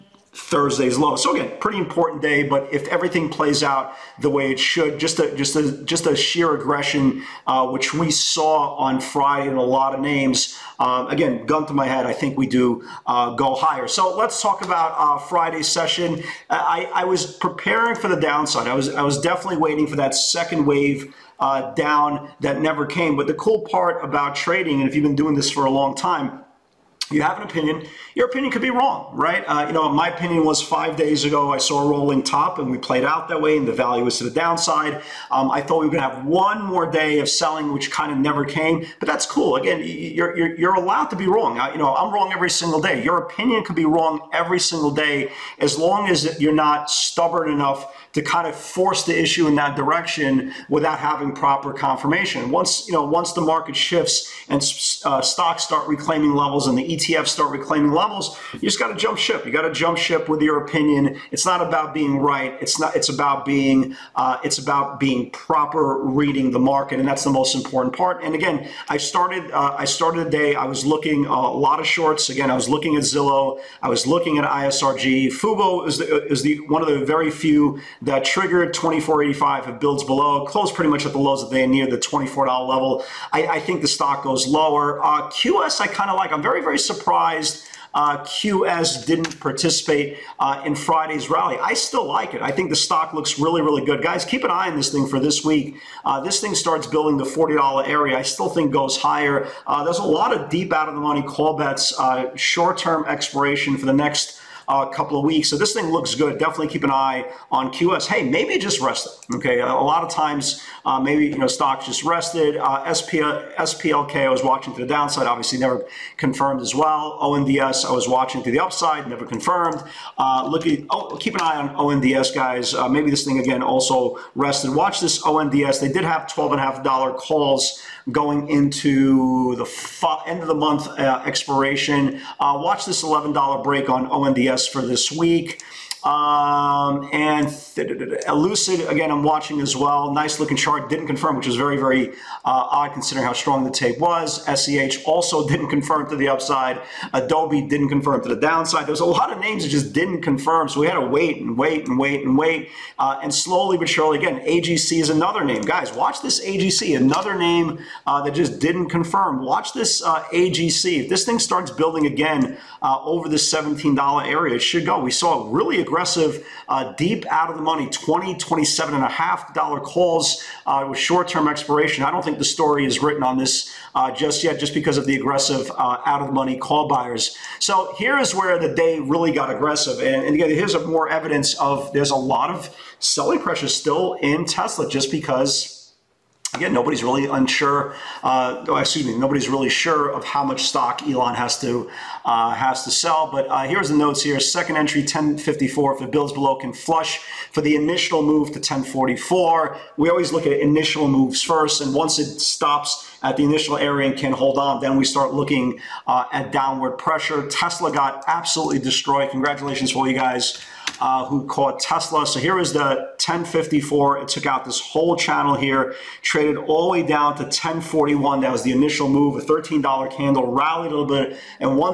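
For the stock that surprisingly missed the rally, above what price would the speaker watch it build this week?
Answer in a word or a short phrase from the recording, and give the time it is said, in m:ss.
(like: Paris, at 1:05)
$40, at 1:37.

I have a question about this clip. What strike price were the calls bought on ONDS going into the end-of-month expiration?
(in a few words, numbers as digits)
$12.50.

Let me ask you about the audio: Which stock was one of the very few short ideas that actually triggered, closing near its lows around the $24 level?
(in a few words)
Fubo.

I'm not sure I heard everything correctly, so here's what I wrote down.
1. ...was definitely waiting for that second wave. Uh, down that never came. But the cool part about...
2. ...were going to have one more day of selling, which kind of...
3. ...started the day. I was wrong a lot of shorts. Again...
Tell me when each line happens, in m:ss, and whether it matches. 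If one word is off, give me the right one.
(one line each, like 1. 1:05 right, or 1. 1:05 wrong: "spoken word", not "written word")
1. 0:19 right
2. 0:35 right
3. 1:09 wrong: "looking", not "wrong".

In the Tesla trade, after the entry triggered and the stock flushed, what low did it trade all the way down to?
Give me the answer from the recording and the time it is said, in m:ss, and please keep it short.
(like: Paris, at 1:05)
1041, at 3:37.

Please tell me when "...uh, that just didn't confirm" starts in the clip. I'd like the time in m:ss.
2:38.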